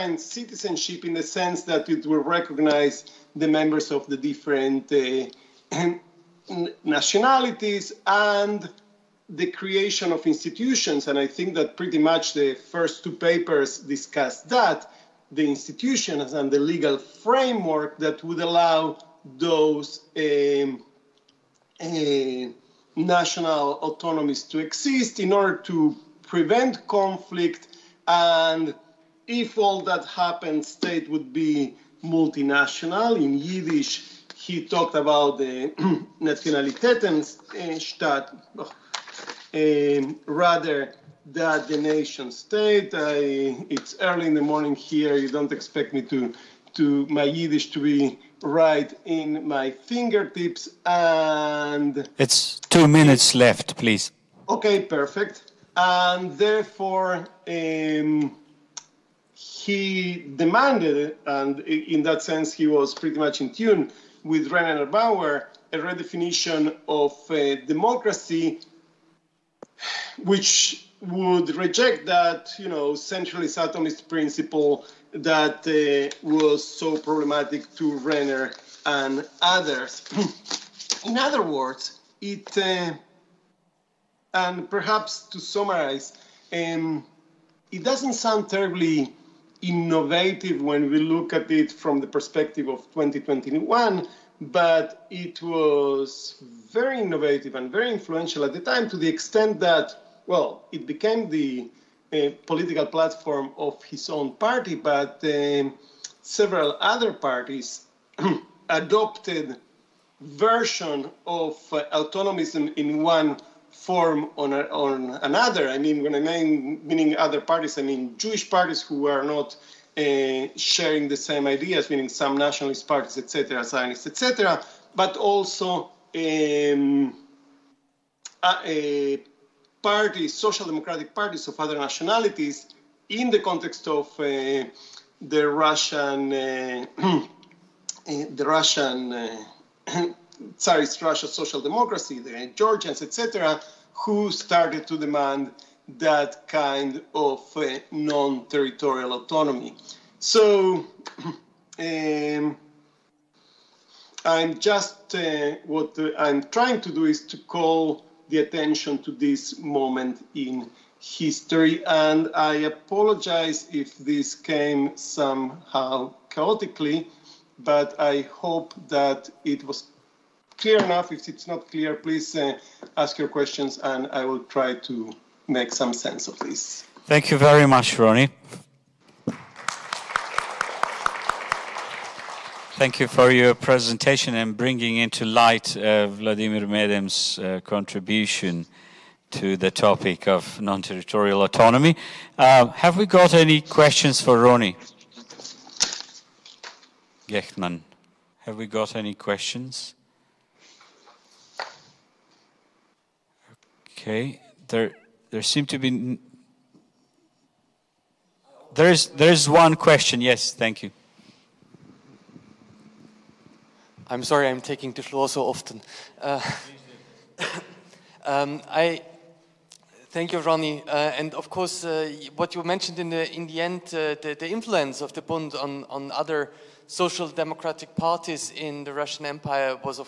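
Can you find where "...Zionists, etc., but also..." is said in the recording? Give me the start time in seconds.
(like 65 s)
123 s.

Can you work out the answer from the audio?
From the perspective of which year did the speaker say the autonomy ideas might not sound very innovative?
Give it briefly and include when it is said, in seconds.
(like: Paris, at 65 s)
2021, at 92 s.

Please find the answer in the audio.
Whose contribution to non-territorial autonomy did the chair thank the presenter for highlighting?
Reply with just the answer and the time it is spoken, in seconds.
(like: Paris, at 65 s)
Vladimir Medem, at 186 s.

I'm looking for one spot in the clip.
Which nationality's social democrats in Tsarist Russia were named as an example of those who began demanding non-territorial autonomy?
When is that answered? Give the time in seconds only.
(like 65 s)
142 s.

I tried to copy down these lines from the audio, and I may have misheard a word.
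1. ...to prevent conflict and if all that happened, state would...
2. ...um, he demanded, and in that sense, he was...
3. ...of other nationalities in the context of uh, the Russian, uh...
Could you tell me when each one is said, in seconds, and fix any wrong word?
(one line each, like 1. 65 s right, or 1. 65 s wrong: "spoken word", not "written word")
1. 25 s right
2. 57 s right
3. 131 s right.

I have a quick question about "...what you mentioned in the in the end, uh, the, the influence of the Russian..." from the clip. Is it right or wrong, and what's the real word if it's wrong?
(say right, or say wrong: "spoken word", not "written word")
wrong: "Bund", not "Russian".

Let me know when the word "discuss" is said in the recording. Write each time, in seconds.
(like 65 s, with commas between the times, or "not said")
13 s.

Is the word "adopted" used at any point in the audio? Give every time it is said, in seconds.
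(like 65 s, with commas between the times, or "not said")
108 s.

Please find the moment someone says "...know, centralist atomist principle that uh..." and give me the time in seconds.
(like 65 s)
72 s.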